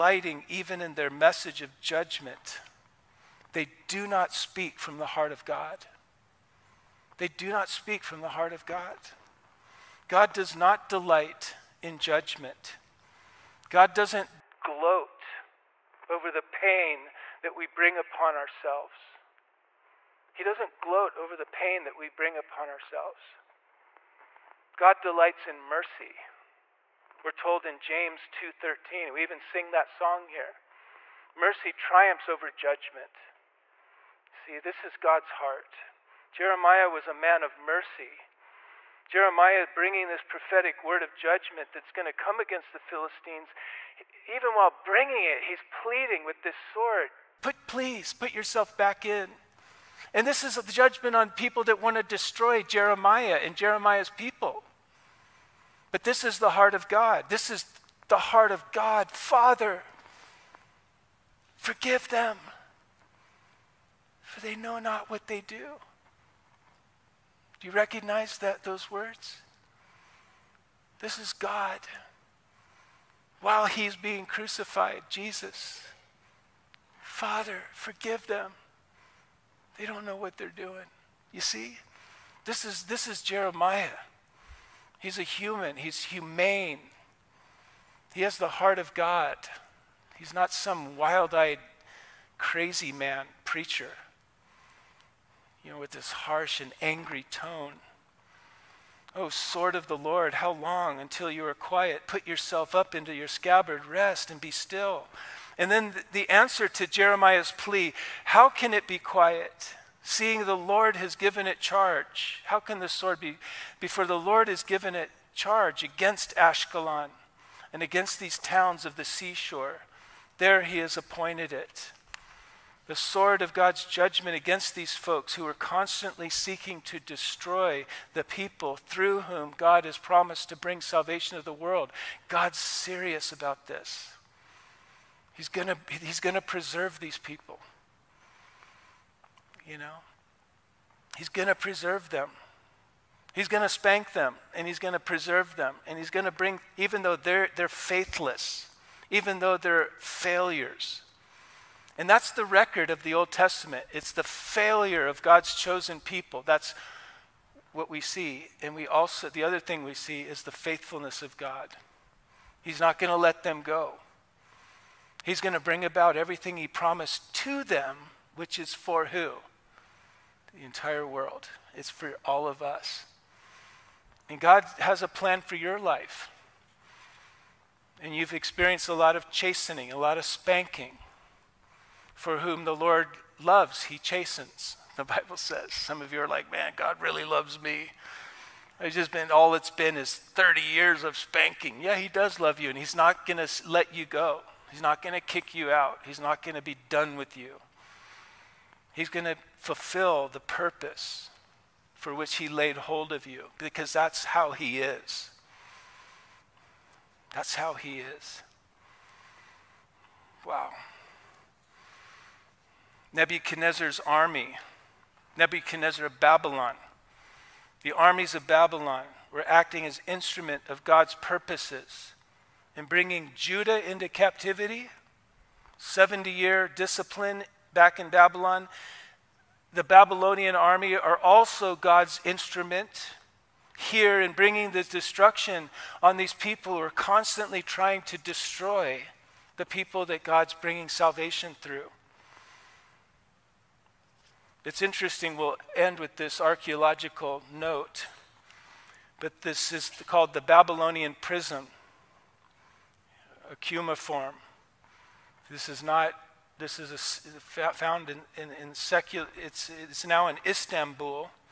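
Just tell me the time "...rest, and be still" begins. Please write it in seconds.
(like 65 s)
103 s.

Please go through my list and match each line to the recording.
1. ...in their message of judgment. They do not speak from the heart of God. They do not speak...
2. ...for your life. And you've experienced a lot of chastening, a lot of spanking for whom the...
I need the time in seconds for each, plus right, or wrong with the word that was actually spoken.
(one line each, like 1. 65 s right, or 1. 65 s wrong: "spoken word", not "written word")
1. 0 s right
2. 175 s right.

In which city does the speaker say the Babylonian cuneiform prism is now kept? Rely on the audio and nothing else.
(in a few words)
Istanbul.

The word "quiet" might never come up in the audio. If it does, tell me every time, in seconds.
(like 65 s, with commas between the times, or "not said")
101 s, 108 s.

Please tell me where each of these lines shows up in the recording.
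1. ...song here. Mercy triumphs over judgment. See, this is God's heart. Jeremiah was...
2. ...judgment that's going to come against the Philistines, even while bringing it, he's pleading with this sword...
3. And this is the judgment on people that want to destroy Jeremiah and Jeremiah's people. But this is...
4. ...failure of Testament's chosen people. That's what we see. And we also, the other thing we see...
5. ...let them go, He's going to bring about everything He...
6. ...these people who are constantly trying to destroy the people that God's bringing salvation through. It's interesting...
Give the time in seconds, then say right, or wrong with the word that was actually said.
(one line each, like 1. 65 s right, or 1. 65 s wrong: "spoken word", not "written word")
1. 29 s right
2. 41 s right
3. 50 s right
4. 154 s wrong: "God", not "Testament"
5. 163 s right
6. 236 s right.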